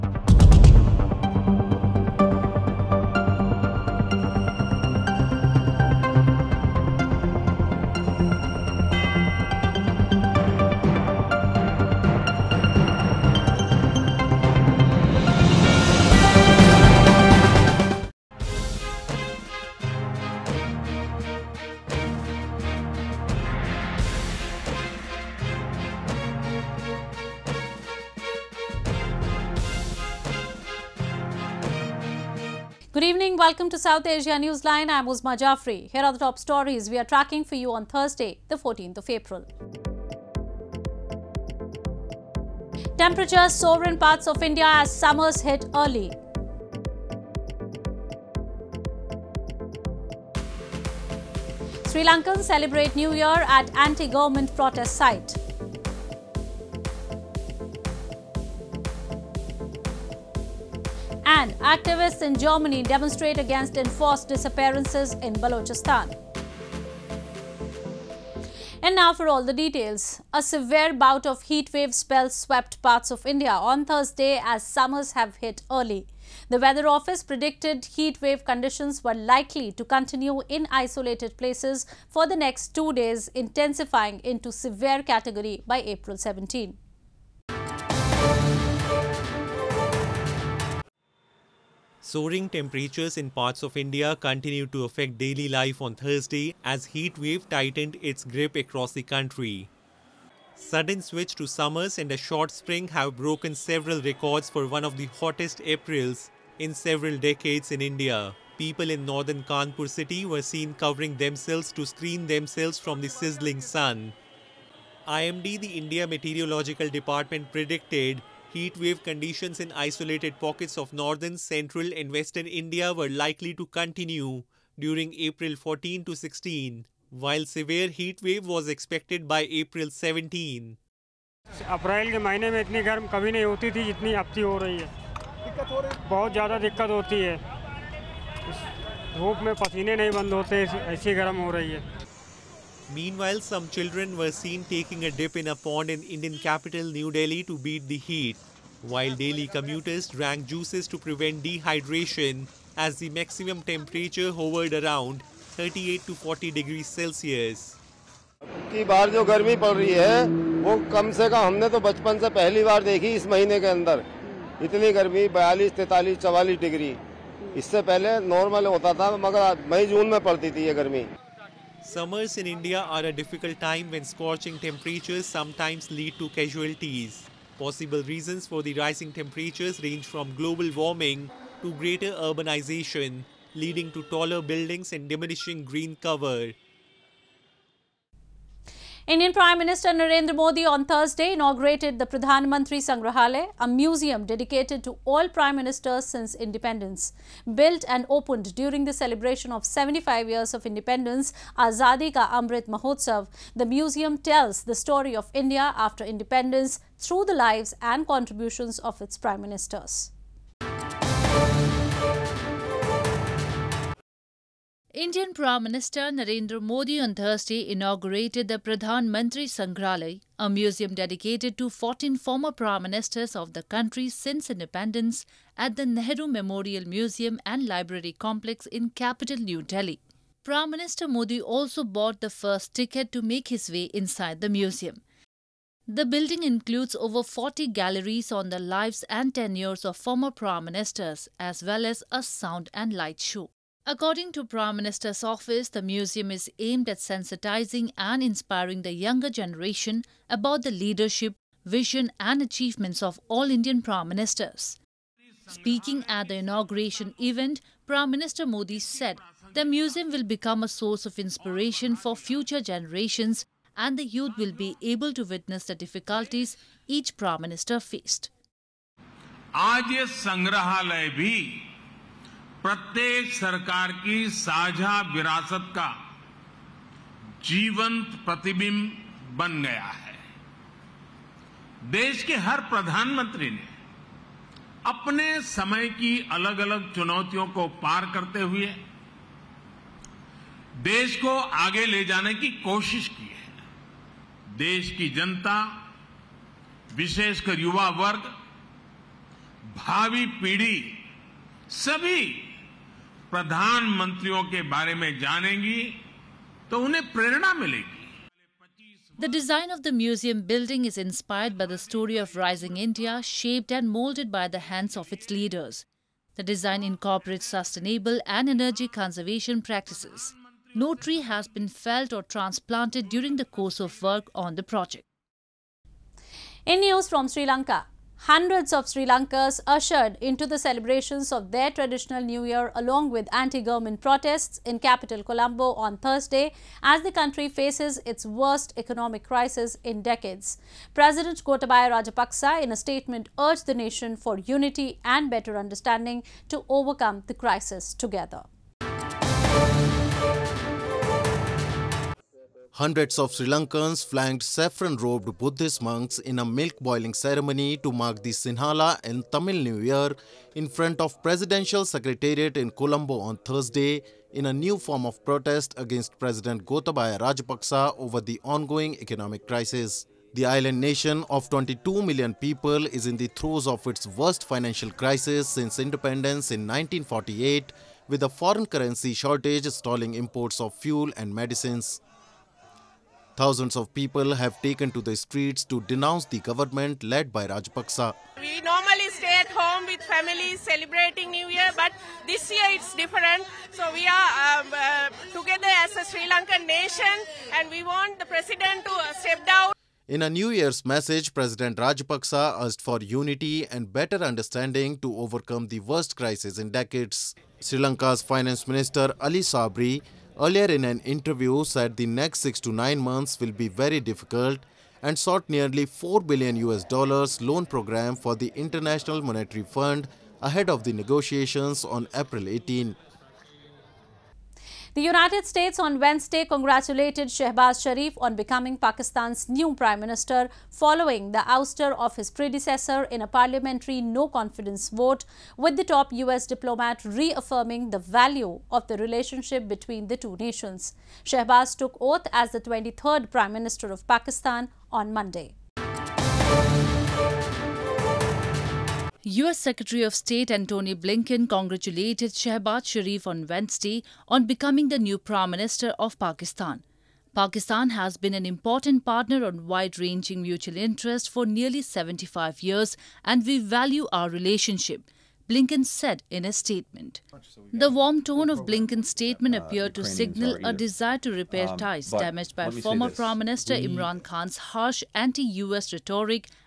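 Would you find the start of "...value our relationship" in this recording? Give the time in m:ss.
7:43.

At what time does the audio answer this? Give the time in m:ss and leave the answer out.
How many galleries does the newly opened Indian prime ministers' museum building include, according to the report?
3:56.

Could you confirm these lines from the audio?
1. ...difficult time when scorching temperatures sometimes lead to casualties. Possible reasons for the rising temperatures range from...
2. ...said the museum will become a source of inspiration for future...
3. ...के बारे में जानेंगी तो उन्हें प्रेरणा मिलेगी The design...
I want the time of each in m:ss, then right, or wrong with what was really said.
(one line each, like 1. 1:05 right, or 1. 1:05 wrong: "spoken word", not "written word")
1. 2:53 right
2. 4:18 right
3. 5:04 right.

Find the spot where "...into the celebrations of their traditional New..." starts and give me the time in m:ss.
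5:30.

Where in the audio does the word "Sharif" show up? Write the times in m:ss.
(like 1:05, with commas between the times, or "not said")
7:07, 7:32.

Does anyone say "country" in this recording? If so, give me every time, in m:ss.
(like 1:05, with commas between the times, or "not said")
1:39, 3:43, 5:37.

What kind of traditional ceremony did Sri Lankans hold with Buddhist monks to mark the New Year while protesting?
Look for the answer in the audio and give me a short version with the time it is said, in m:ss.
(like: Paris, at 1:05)
milk-boiling ceremony, at 5:56.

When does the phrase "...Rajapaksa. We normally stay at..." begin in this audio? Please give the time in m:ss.
6:27.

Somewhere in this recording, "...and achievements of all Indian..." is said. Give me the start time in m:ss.
4:12.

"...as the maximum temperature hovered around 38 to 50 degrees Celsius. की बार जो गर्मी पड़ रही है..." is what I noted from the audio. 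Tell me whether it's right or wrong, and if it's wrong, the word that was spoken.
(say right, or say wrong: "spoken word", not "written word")
wrong: "40", not "50".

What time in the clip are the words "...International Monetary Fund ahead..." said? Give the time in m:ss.
6:58.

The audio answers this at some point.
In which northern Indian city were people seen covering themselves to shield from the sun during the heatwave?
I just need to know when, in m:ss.
1:49.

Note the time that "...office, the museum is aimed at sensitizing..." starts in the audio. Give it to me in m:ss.
4:05.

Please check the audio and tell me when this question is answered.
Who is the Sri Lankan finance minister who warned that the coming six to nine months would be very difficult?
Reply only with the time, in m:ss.
6:49.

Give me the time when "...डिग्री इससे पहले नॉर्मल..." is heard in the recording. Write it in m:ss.
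2:46.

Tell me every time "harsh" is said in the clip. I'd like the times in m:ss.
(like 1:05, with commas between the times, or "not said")
7:54.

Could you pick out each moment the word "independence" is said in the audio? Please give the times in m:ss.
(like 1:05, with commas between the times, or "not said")
3:16, 3:20, 3:26, 3:44, 6:15.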